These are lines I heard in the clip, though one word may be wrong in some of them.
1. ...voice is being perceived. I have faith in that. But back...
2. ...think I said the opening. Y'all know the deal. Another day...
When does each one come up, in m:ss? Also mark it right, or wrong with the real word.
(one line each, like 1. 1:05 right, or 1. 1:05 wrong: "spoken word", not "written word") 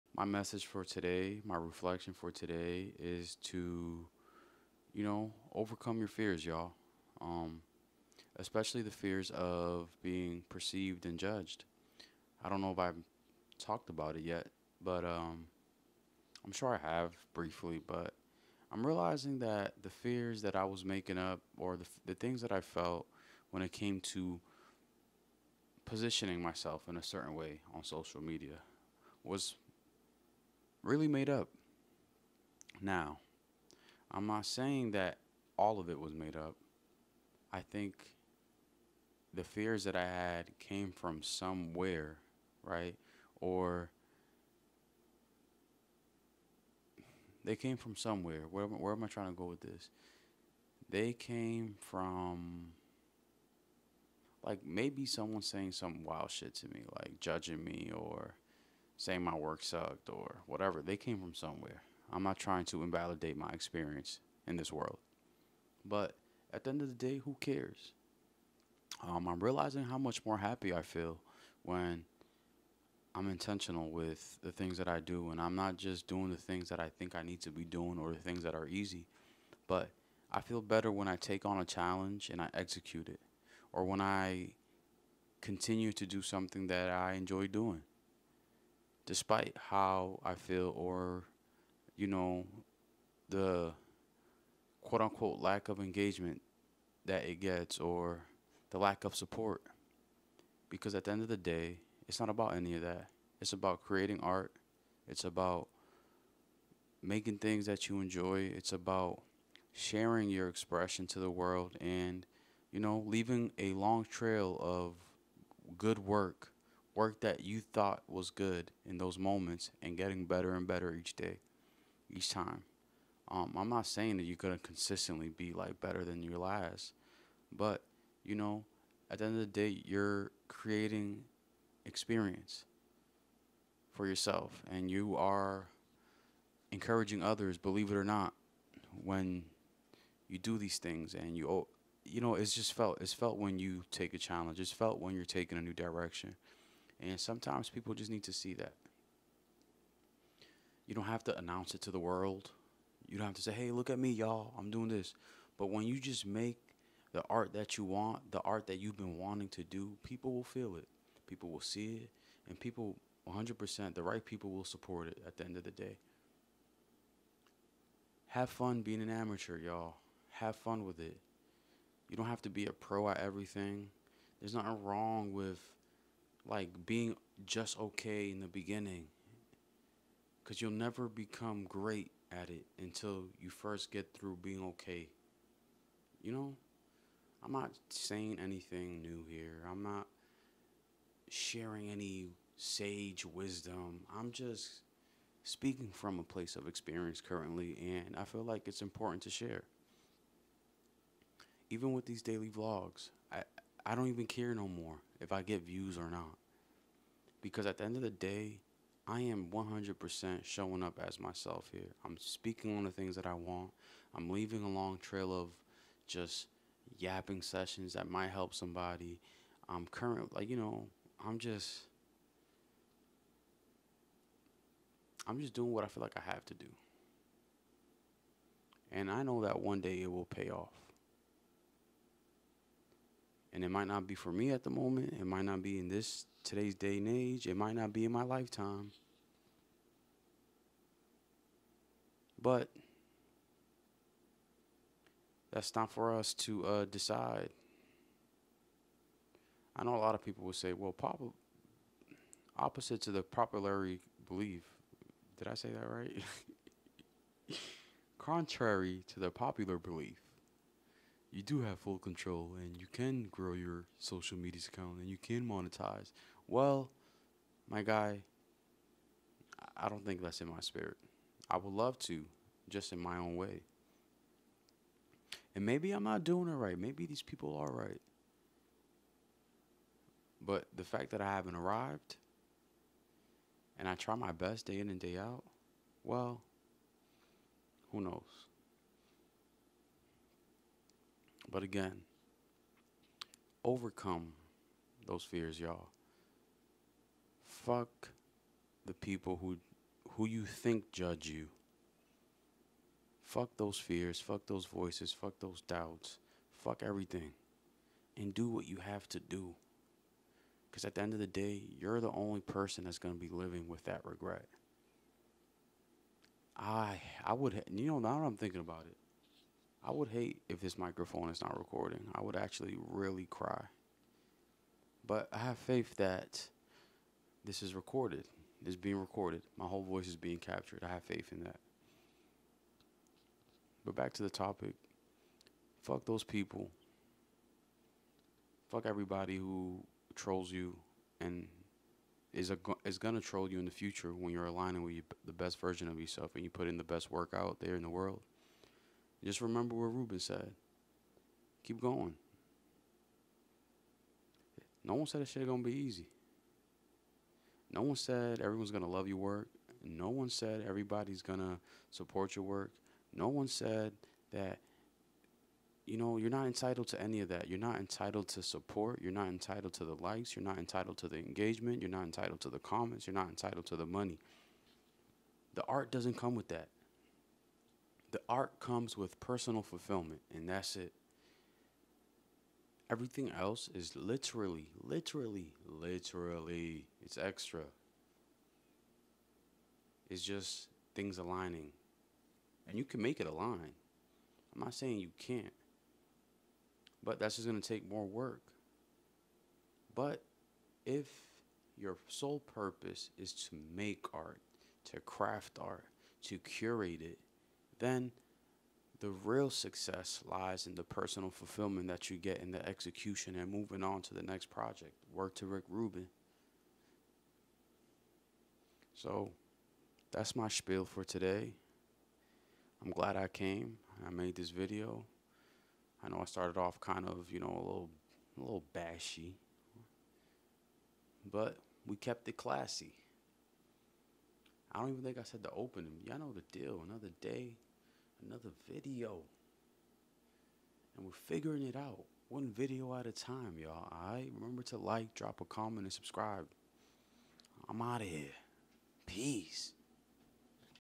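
1. 5:29 wrong: "captured", not "perceived"
2. 7:15 right.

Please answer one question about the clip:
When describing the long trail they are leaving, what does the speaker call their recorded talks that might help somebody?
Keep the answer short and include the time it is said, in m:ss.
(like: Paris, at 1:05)
yapping sessions, at 3:36.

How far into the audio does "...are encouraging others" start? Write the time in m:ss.
2:15.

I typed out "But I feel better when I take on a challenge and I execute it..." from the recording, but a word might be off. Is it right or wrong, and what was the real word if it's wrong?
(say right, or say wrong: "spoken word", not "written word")
right.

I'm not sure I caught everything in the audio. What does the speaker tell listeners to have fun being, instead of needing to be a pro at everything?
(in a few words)
an amateur.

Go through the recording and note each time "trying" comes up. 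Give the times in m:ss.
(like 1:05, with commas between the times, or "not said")
0:49, 1:02.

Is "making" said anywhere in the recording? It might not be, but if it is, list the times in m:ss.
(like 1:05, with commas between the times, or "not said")
0:20, 1:47.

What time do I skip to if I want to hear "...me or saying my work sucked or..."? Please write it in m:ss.
0:57.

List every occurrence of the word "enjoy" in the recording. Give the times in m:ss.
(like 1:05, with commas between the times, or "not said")
1:27, 1:47.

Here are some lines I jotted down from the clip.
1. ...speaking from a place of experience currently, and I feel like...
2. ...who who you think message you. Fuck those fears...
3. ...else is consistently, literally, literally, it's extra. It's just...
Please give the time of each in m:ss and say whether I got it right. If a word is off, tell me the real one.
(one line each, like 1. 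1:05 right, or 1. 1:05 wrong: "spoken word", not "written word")
1. 3:15 right
2. 4:59 wrong: "judge", not "message"
3. 6:23 wrong: "literally", not "consistently".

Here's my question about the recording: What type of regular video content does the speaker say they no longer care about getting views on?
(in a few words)
daily vlogs.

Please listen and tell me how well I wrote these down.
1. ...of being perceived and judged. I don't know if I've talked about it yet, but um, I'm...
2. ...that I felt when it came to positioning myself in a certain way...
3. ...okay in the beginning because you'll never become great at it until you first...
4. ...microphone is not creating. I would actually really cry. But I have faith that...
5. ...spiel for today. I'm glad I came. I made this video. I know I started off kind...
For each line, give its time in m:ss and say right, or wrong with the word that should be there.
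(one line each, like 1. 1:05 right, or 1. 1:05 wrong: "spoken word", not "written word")
1. 0:09 right
2. 0:22 right
3. 2:57 right
4. 5:20 wrong: "recording", not "creating"
5. 7:00 right.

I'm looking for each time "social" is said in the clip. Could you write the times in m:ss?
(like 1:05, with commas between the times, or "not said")
0:27, 4:23.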